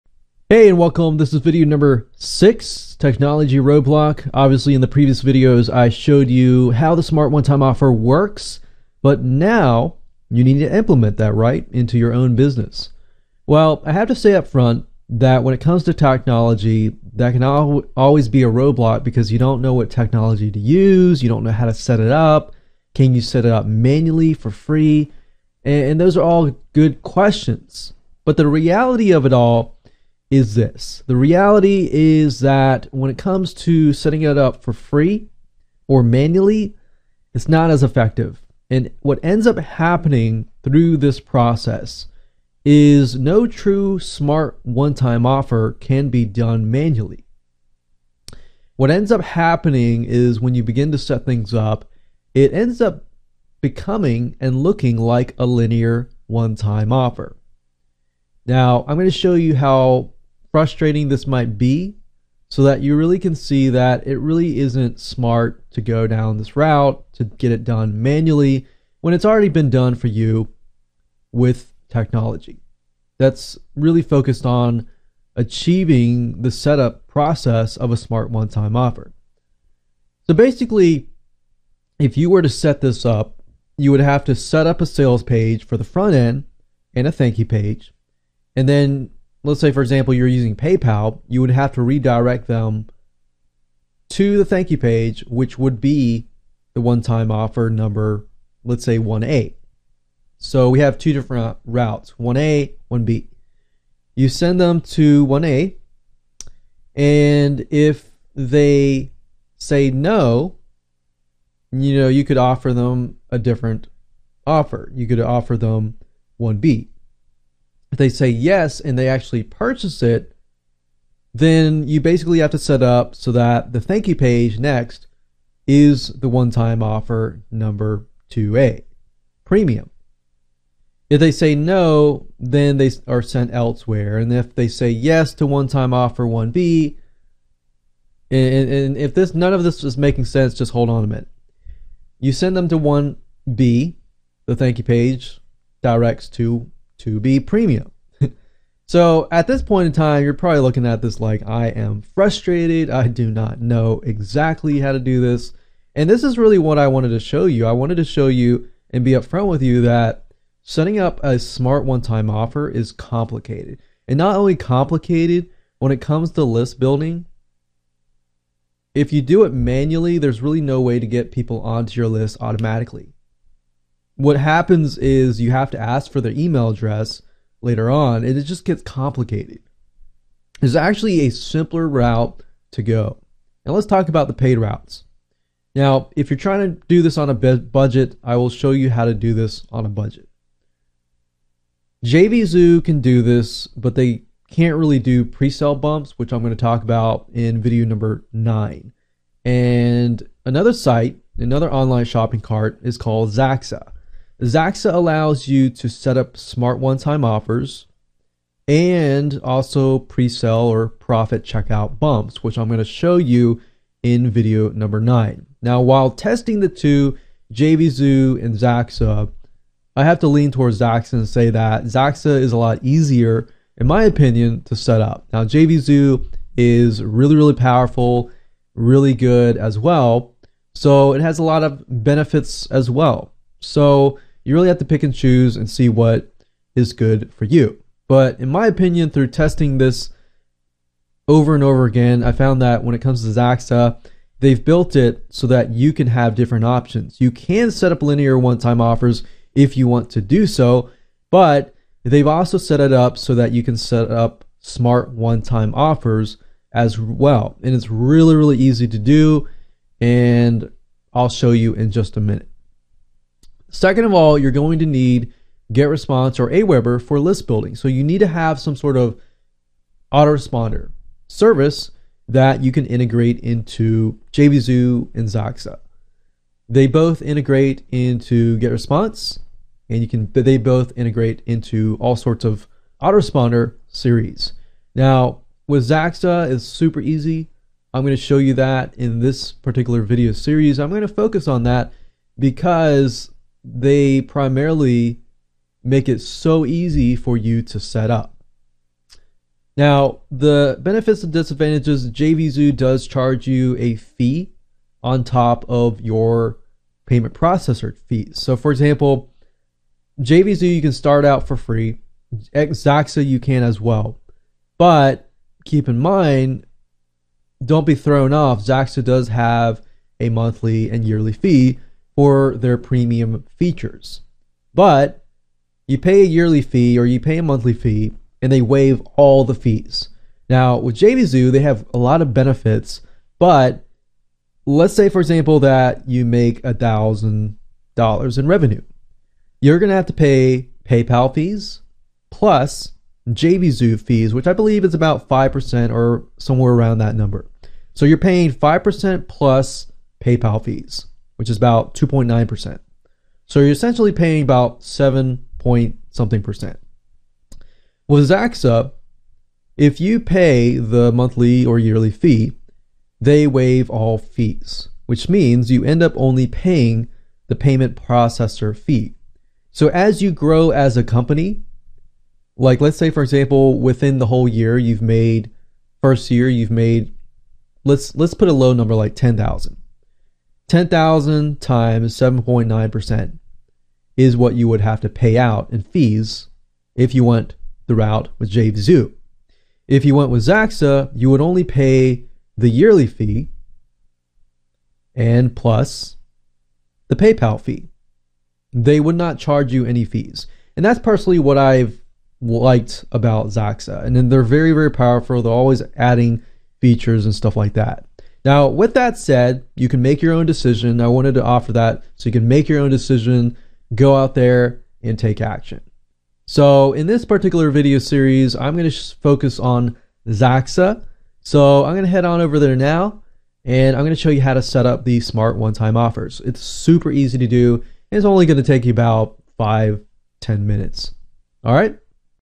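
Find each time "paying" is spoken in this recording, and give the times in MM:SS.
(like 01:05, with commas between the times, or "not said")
05:48, 05:54, 06:06.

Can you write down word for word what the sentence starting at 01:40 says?
So we have two different routes 1A, 1B.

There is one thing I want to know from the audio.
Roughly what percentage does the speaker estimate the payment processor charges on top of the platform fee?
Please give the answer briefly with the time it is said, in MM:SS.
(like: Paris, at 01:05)
2.9%, at 05:51.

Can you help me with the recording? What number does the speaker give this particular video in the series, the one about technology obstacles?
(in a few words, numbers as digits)
6.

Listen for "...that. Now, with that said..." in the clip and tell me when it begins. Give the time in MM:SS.
06:47.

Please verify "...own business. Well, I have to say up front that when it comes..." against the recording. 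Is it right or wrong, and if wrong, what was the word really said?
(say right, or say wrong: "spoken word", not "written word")
right.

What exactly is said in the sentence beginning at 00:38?
And what ends up happening through this process is no true smart one time offer can be done manually.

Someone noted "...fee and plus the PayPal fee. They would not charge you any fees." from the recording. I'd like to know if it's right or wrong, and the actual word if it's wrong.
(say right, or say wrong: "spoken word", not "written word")
right.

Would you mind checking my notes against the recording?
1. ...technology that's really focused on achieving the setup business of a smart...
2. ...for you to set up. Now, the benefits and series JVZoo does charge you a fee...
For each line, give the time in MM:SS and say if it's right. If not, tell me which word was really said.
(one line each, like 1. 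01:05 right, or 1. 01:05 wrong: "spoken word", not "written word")
1. 01:11 wrong: "process", not "business"
2. 04:57 wrong: "disadvantages", not "series".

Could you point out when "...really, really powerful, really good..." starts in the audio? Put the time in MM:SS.
03:47.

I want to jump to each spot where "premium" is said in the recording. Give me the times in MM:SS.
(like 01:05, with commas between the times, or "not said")
02:09, 02:27, 05:22.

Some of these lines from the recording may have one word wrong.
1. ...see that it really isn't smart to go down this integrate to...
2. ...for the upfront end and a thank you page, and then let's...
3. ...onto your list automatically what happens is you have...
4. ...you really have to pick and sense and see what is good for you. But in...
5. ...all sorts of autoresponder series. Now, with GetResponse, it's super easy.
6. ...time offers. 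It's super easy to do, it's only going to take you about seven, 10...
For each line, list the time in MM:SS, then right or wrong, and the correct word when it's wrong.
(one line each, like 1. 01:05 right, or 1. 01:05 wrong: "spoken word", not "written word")
1. 01:03 wrong: "route", not "integrate"
2. 01:25 wrong: "front", not "upfront"
3. 02:51 right
4. 03:54 wrong: "choose", not "sense"
5. 04:42 wrong: "Zaxaa", not "GetResponse"
6. 07:05 wrong: "five", not "seven".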